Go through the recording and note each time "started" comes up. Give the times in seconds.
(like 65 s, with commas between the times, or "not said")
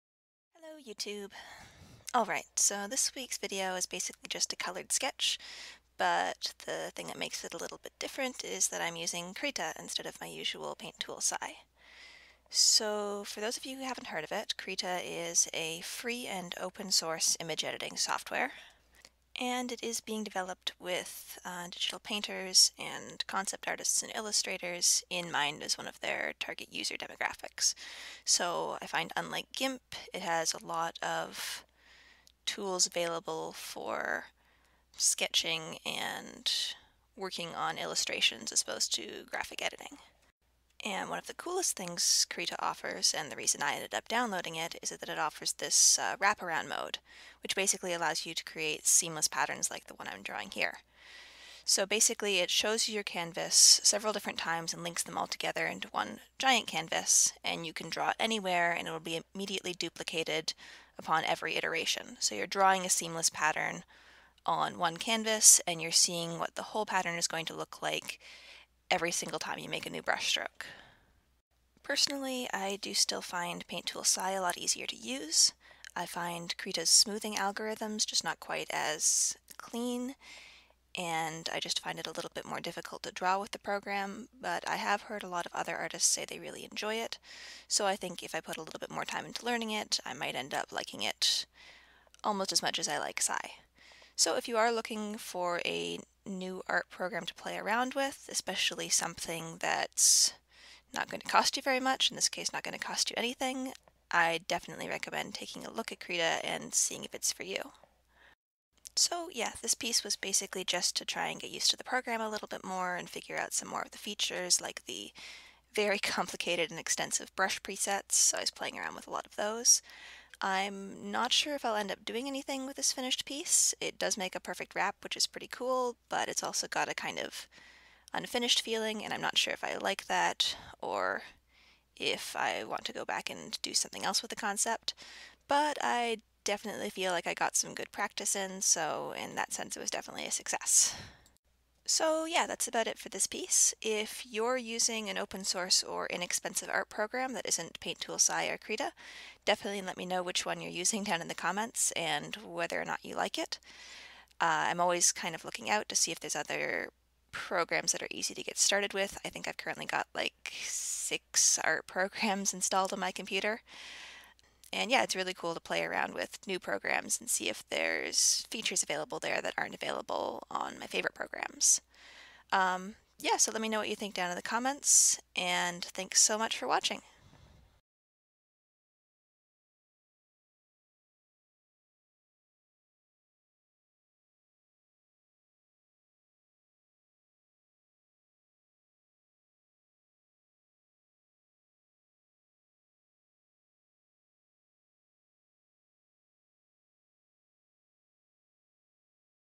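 158 s.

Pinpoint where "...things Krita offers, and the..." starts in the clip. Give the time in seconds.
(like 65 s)
41 s.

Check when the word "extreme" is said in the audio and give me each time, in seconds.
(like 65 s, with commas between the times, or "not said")
not said.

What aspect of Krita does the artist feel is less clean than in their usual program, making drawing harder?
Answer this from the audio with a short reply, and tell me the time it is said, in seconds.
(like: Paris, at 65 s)
smoothing algorithms, at 76 s.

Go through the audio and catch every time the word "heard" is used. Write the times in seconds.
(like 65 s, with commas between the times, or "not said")
14 s, 85 s.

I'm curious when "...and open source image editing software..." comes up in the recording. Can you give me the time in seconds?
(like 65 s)
16 s.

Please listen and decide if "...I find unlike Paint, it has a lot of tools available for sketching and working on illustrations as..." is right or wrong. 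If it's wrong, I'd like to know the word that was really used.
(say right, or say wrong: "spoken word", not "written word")
wrong: "GIMP", not "Paint".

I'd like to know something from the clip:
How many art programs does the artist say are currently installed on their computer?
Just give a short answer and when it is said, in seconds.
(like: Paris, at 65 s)
6, at 160 s.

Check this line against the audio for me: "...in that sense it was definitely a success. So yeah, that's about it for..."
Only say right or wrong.
right.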